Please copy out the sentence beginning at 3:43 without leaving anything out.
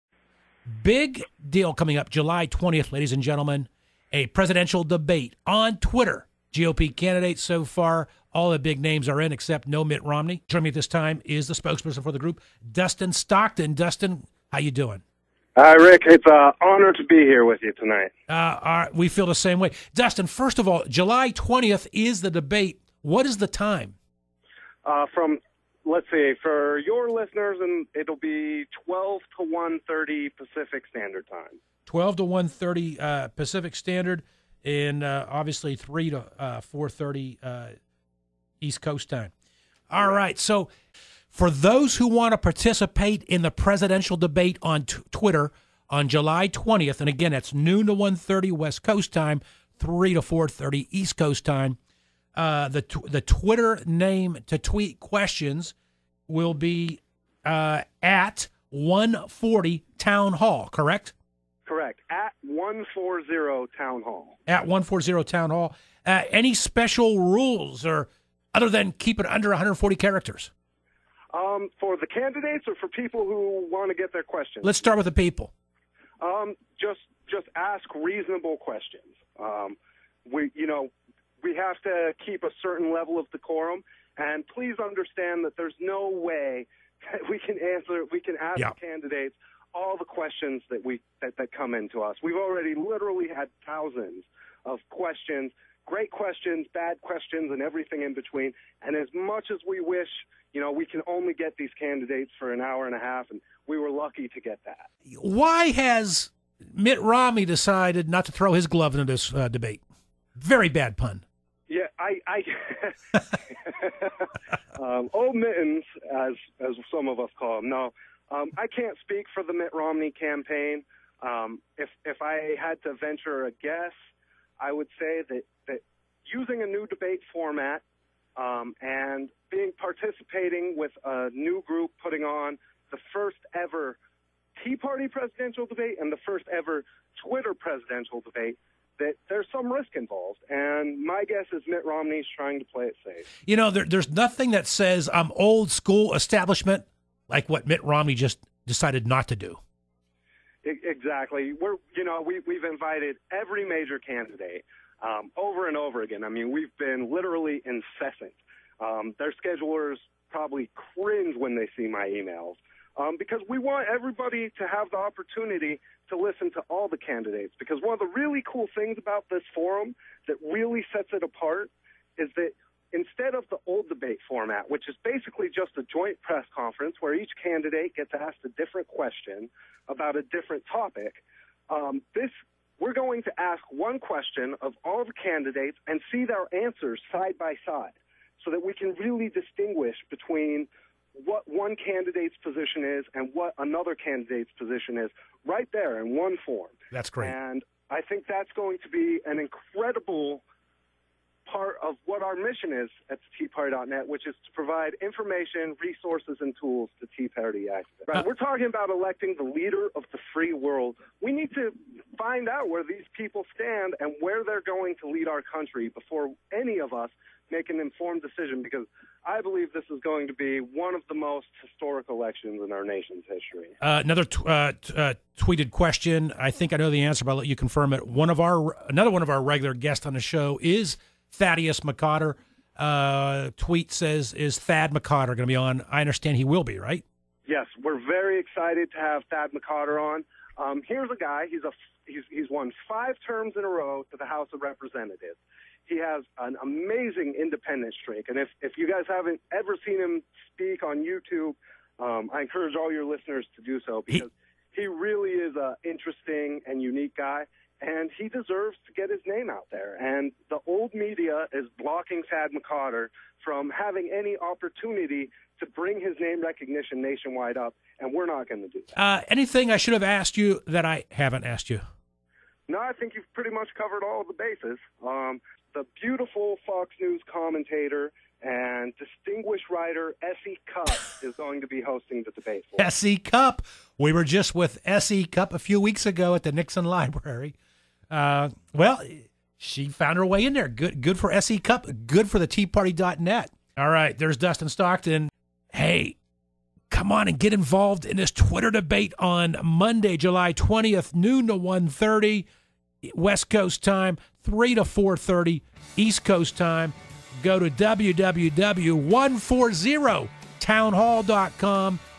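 Uh, another t- uh, t- uh, tweeted question.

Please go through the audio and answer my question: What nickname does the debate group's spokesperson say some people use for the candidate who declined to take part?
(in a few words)
Old Mittens.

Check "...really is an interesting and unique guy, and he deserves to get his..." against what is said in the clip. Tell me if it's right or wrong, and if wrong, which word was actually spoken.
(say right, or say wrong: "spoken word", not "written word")
right.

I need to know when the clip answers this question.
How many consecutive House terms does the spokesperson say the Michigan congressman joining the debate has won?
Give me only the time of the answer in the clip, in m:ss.
4:02.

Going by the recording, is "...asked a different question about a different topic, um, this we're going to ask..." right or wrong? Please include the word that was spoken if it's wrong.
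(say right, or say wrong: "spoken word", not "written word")
right.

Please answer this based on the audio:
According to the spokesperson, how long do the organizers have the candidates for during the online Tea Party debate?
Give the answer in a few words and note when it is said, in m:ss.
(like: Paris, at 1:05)
an hour and a half, at 1:42.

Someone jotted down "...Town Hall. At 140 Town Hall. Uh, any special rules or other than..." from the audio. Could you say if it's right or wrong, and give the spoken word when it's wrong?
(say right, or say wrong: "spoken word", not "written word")
right.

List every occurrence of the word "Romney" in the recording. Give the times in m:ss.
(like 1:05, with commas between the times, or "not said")
0:10, 1:47, 1:59, 2:21, 2:27.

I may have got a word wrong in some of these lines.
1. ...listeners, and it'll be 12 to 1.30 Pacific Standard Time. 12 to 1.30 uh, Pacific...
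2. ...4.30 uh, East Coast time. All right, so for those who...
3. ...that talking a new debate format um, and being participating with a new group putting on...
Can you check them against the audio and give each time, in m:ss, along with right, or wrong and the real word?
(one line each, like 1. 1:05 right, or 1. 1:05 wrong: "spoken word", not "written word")
1. 0:27 right
2. 0:36 right
3. 2:05 wrong: "using", not "talking".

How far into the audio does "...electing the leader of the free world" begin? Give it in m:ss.
3:28.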